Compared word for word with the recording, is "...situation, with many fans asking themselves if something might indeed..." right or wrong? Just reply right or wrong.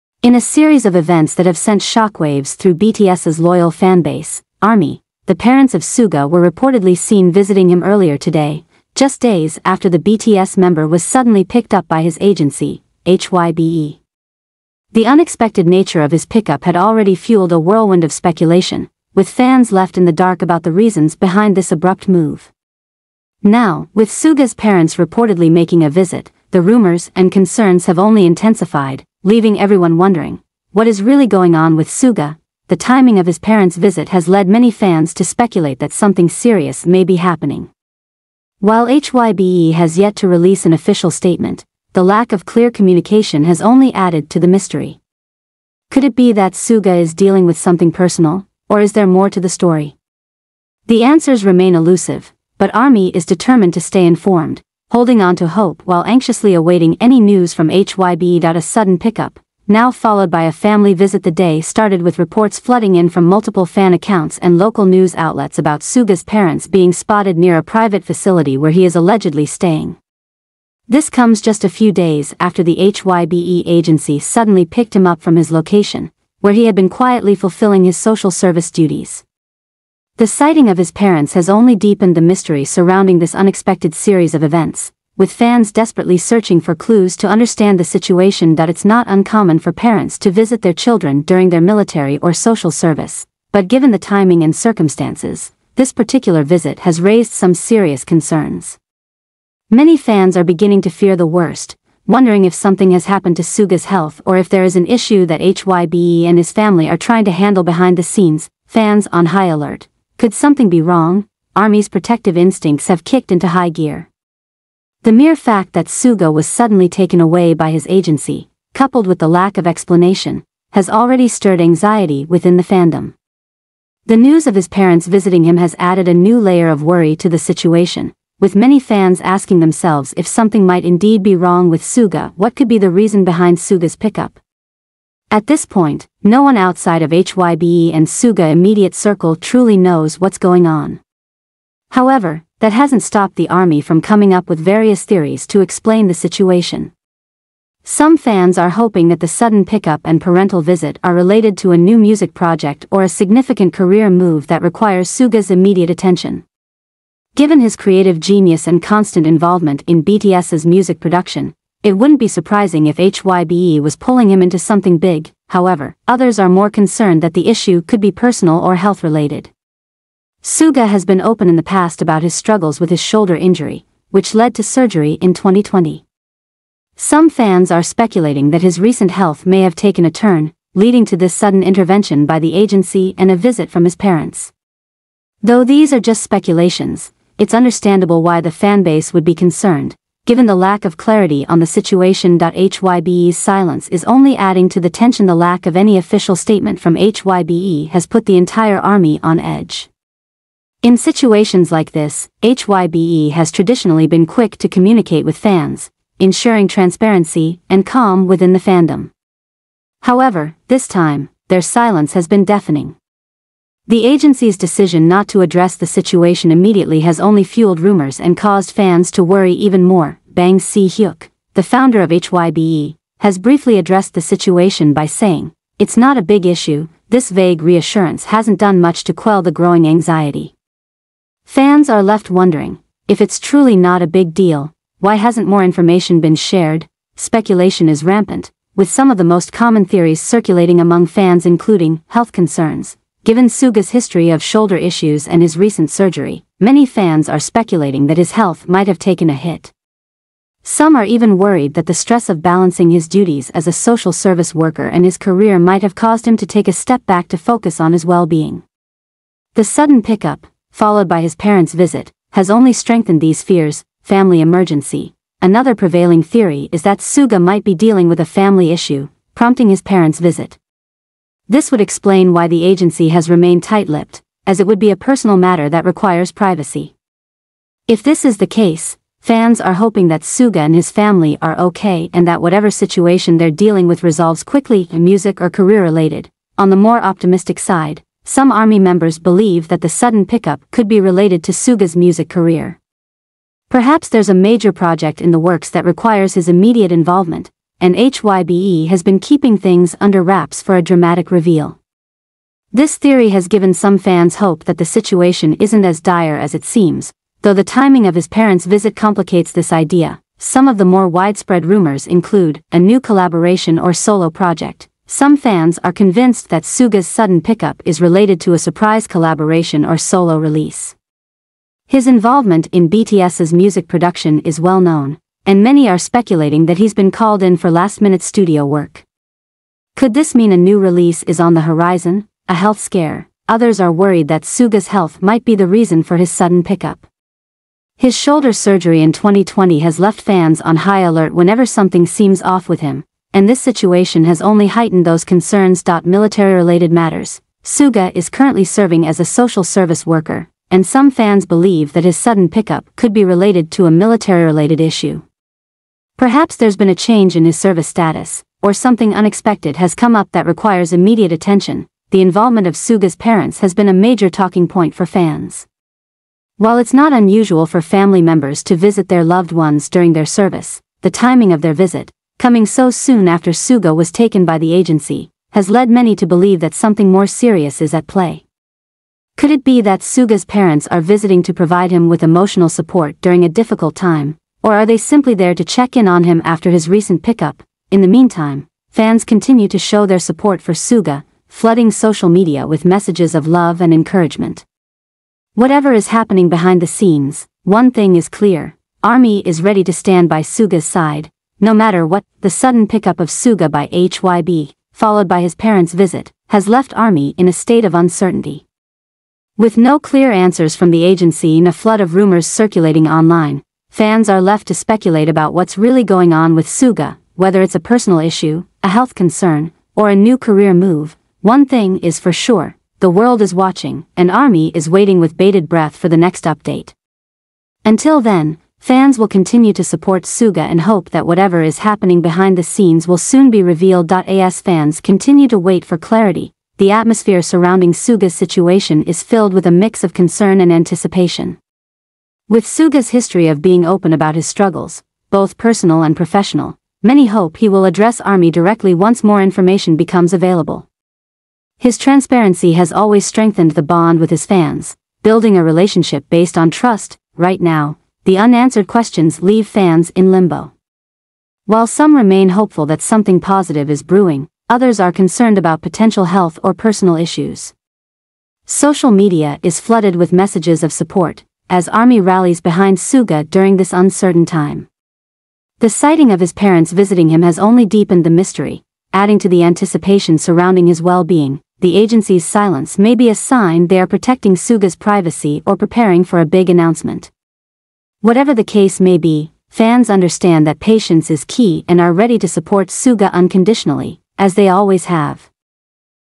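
right.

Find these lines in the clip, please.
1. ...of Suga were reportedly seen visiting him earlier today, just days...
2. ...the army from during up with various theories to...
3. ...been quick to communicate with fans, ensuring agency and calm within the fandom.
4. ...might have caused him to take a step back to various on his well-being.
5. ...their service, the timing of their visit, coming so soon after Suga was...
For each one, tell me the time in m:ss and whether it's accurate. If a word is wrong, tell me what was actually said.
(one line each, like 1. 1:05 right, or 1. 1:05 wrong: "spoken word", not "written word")
1. 0:05 right
2. 2:23 wrong: "coming", not "during"
3. 3:24 wrong: "transparency", not "agency"
4. 4:15 wrong: "focus", not "various"
5. 6:10 right.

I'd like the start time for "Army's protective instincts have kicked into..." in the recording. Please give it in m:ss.
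1:51.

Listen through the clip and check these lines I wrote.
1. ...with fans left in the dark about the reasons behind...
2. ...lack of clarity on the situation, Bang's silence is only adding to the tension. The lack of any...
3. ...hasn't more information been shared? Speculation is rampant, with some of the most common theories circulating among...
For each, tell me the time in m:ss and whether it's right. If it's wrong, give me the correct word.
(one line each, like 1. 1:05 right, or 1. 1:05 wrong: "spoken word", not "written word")
1. 0:19 right
2. 3:10 wrong: "HYBE", not "Bang"
3. 3:55 right.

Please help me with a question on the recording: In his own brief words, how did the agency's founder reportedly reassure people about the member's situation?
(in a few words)
It's not a big issue.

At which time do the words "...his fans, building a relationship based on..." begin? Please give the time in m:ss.
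7:34.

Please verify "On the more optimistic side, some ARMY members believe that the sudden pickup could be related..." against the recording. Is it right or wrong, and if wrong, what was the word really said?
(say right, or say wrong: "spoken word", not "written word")
right.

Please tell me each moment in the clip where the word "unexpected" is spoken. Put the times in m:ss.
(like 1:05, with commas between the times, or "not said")
0:15, 1:23, 5:59.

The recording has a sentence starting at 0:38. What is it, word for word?
While HYBE has yet to release an official statement, the lack of clear communication has only added to the mystery.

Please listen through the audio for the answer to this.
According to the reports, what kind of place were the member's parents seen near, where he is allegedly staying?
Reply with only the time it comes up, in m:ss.
1:07.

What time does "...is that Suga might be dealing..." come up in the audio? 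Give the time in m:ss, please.
4:26.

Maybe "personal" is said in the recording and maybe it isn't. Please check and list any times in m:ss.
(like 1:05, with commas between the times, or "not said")
0:47, 2:48, 4:34, 6:57, 7:25, 7:46.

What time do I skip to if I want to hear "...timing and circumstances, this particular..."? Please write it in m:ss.
1:33.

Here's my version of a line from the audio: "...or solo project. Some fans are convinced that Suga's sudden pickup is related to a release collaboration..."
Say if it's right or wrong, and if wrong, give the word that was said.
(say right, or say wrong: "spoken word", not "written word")
wrong: "surprise", not "release".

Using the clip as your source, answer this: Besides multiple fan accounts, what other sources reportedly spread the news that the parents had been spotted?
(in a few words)
local news outlets.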